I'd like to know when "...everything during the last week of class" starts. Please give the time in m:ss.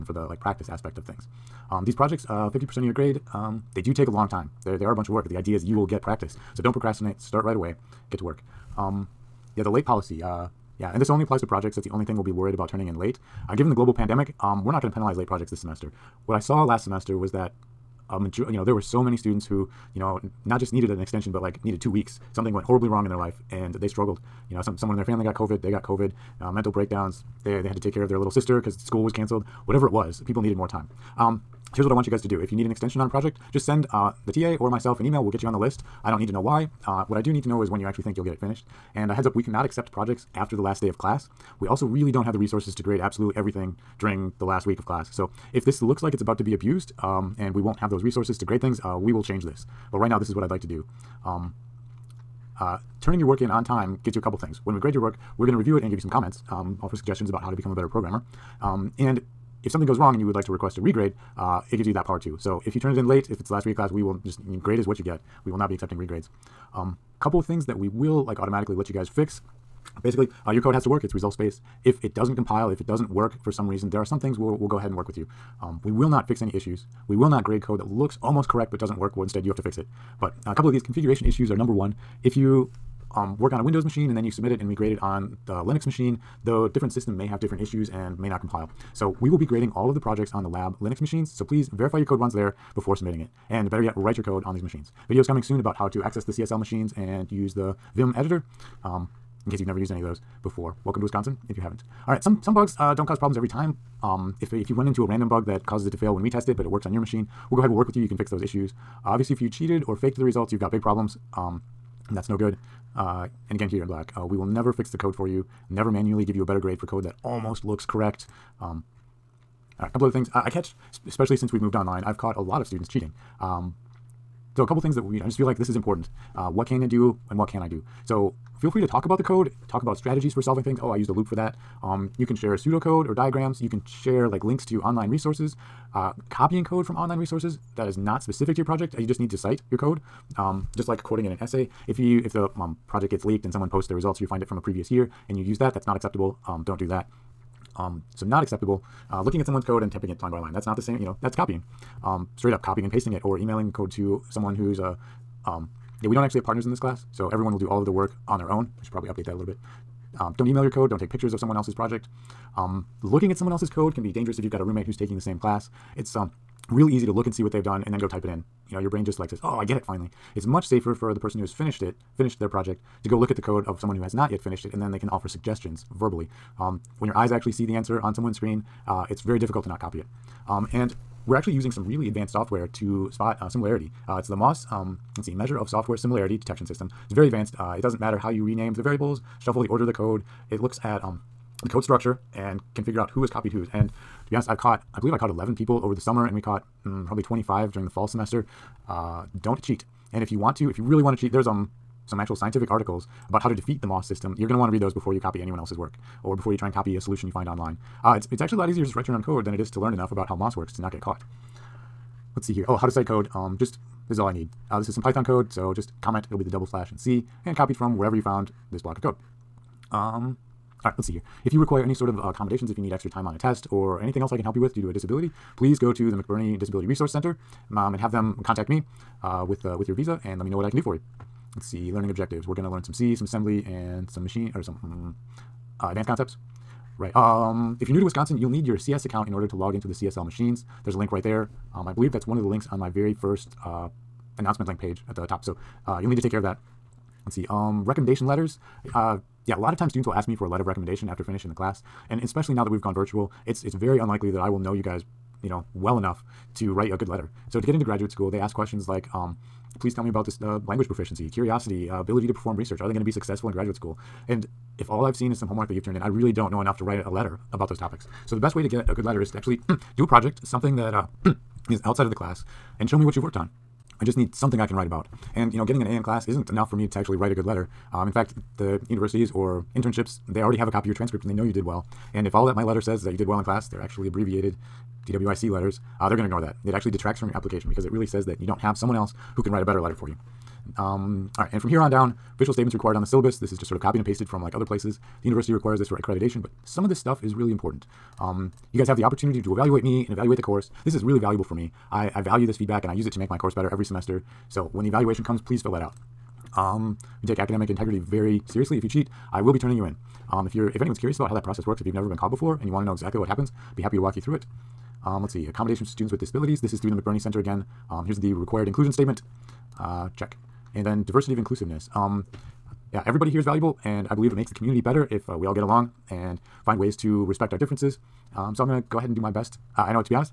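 0:43.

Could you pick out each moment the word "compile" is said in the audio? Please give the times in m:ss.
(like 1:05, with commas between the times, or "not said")
1:12, 1:28.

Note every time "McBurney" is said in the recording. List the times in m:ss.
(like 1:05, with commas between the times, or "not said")
3:46, 5:17.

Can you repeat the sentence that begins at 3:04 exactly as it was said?
Uh, it's the MOSS, um, let's see, Measure of Software Similarity Detection System.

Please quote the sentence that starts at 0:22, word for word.
Something went horribly wrong in their life and they struggled.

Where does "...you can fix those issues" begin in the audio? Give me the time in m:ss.
1:48.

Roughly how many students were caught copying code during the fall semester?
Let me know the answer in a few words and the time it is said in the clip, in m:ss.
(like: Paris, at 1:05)
25, at 3:17.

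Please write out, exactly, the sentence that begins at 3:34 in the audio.
Uh, this is some Python code, so just comment.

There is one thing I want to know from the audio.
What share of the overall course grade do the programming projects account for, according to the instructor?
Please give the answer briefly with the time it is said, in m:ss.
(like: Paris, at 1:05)
50%, at 0:02.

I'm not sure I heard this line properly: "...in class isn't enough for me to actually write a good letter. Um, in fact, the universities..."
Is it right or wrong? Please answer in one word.
right.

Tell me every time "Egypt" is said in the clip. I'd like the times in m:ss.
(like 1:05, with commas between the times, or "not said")
not said.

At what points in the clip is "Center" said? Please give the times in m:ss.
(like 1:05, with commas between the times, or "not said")
3:47, 5:17.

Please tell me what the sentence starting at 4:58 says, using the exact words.
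Um, you guys have the opportunity to evaluate me and evaluate the course.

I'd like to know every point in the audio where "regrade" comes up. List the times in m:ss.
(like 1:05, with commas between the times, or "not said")
1:00, 1:05.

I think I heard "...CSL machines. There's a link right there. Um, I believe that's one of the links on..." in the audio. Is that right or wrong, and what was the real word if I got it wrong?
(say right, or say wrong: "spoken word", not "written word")
right.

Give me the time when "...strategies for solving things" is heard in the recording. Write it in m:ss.
2:09.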